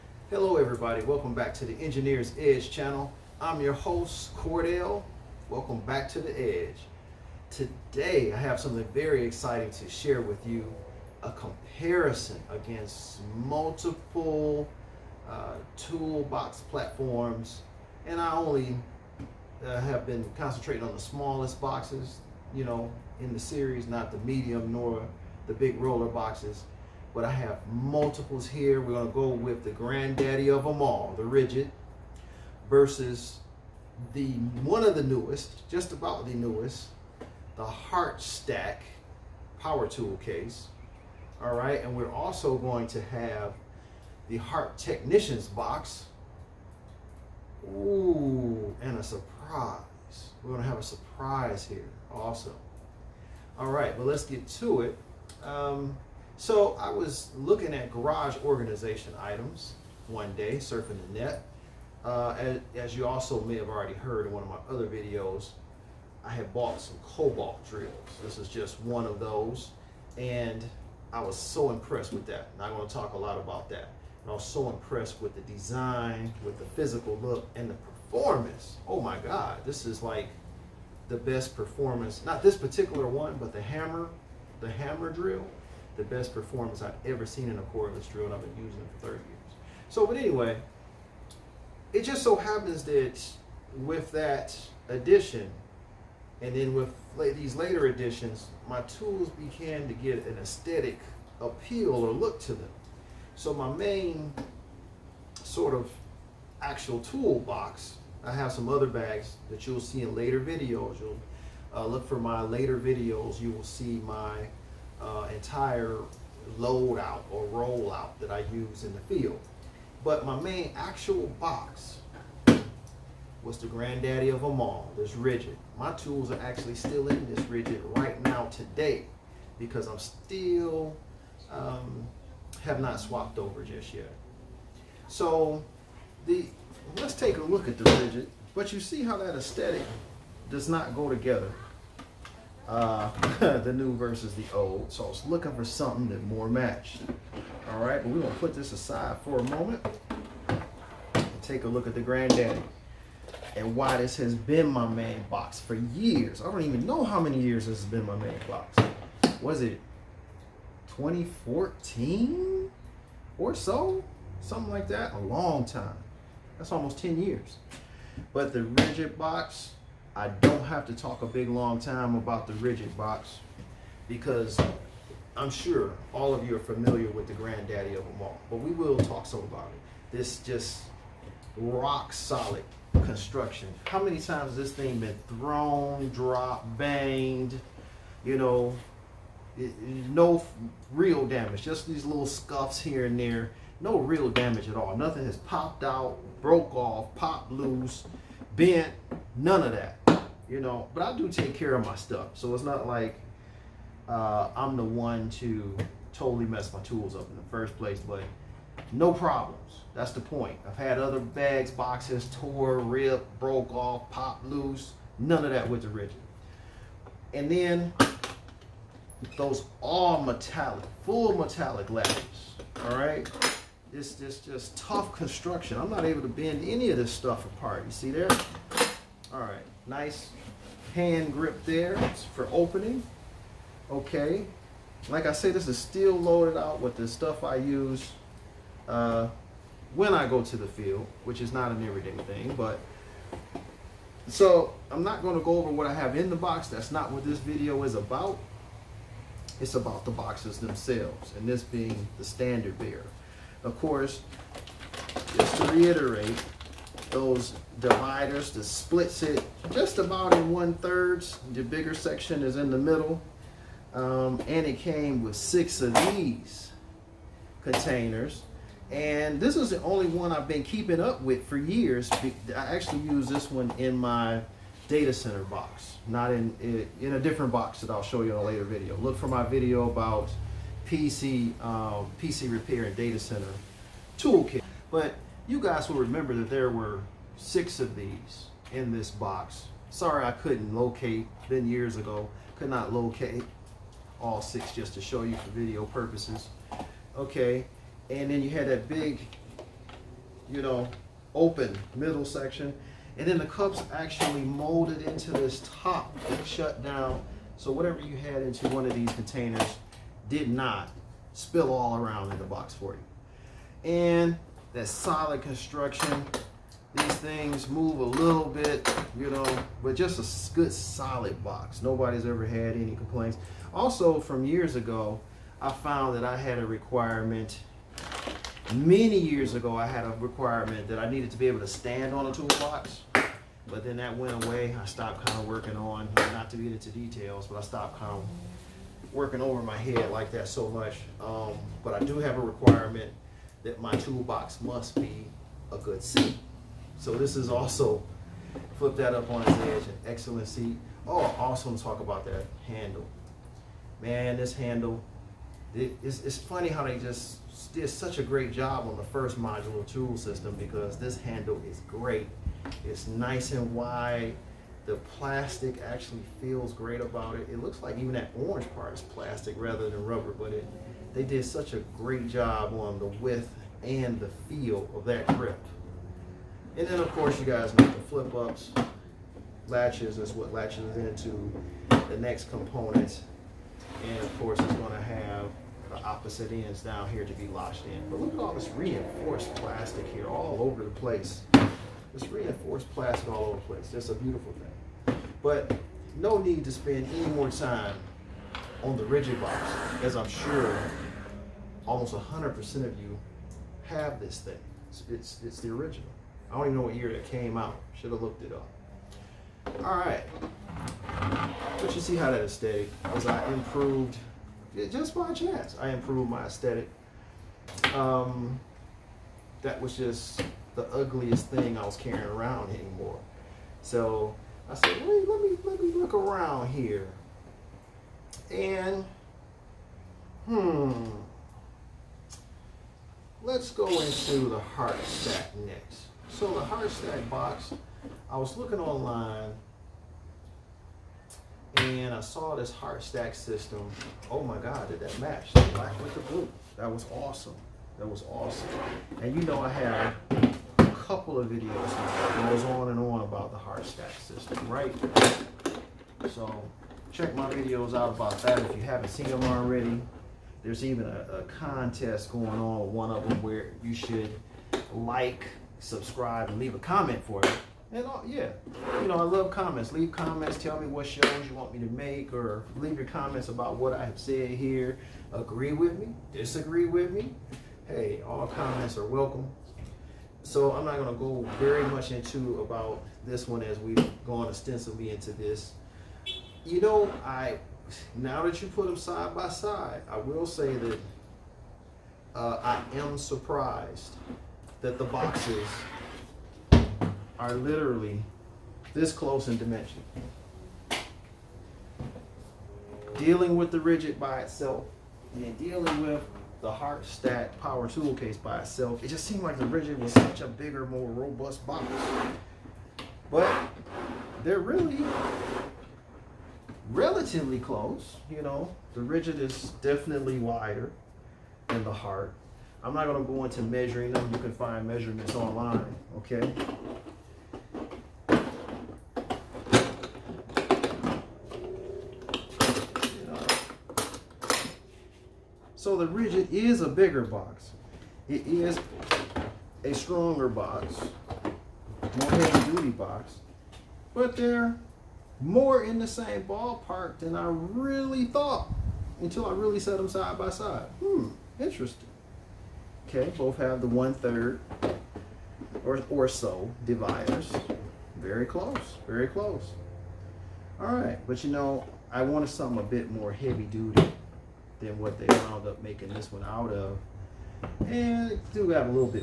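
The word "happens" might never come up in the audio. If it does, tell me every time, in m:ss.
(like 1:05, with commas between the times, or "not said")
1:32.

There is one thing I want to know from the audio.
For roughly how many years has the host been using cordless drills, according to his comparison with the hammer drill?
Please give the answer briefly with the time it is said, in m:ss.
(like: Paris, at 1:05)
30, at 1:29.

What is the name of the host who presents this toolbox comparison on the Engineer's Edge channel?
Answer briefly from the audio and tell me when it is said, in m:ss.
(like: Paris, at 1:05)
Cordell, at 0:04.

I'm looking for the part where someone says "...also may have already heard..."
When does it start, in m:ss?
1:03.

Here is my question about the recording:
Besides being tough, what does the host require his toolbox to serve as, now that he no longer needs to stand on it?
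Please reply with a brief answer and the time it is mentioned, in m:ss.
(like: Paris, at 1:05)
A good seat, at 5:45.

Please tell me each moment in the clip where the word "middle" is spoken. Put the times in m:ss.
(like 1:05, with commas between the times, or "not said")
4:22, 5:01.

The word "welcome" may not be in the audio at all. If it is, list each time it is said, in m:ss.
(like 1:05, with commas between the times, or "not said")
0:01, 0:05, 7:59.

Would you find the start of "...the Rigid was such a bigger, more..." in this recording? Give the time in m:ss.
8:29.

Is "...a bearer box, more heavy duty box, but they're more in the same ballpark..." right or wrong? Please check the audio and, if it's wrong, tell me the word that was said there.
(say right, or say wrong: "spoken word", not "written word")
wrong: "stronger", not "bearer".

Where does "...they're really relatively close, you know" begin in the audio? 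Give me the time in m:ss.
8:34.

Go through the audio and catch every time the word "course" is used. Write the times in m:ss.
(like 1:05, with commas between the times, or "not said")
4:13, 6:17, 6:24.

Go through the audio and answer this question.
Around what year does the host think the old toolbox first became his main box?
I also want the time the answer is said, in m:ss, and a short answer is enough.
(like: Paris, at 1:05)
2014, at 2:40.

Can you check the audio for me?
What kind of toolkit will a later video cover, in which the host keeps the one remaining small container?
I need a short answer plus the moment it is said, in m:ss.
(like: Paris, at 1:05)
PC repair and data center toolkit, at 4:42.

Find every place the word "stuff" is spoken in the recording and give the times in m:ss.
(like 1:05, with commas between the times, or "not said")
3:21, 3:47, 3:57.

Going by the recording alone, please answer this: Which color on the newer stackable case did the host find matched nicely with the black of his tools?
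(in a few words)
Blue.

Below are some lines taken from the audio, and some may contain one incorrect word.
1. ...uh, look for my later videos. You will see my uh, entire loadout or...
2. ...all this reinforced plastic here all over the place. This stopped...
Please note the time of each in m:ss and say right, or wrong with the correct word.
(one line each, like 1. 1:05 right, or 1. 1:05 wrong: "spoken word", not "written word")
1. 1:51 right
2. 6:28 wrong: "reinforced", not "stopped".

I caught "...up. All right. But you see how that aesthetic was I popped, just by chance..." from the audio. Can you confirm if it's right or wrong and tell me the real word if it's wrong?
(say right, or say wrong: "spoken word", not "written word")
wrong: "improved", not "popped".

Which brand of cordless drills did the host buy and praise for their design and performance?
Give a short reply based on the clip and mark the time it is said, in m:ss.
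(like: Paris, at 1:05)
Kobalt, at 1:07.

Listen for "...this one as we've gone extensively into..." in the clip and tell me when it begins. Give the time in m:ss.
8:03.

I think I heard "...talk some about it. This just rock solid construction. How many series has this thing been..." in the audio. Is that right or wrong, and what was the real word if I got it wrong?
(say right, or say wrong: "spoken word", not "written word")
wrong: "times", not "series".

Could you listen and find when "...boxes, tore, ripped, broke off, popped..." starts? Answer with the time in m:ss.
3:31.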